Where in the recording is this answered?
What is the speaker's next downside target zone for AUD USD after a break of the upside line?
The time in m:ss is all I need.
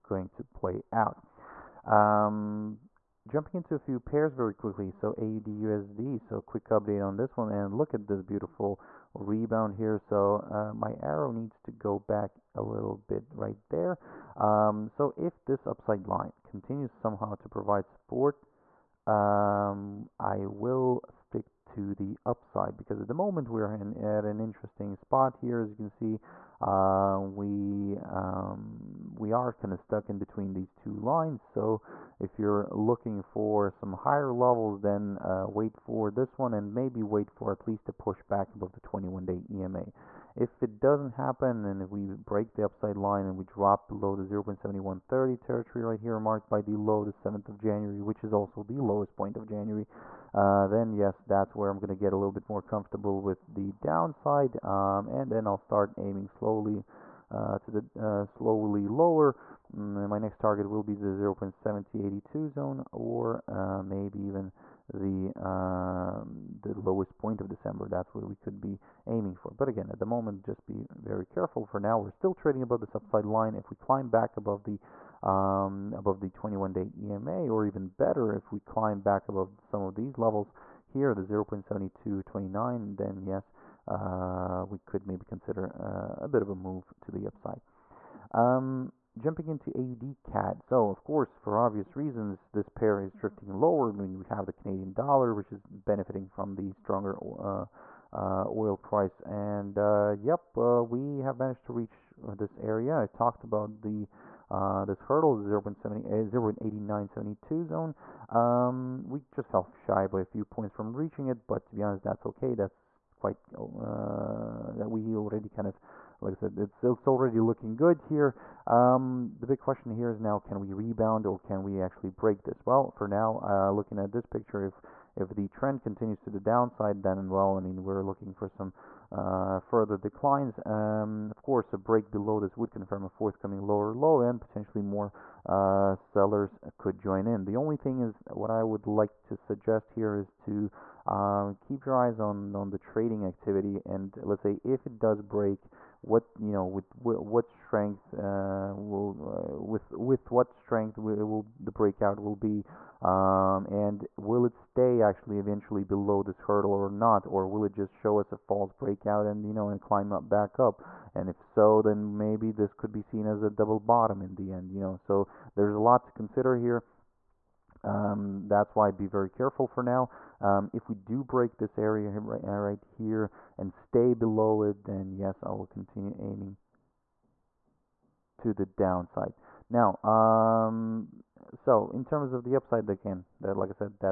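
1:01.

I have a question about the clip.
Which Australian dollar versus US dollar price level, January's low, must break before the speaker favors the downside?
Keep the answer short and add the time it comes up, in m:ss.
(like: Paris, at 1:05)
0.7130, at 0:44.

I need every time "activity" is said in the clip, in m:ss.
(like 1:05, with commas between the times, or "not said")
2:23.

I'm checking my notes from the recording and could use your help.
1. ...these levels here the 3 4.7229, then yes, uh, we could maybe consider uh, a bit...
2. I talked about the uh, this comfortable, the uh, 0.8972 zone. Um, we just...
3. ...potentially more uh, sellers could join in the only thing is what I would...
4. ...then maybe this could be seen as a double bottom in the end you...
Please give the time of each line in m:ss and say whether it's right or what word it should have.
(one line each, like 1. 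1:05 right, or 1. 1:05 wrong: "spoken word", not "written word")
1. 1:19 wrong: "0", not "3"
2. 1:42 wrong: "hurdle", not "comfortable"
3. 2:14 right
4. 2:41 right.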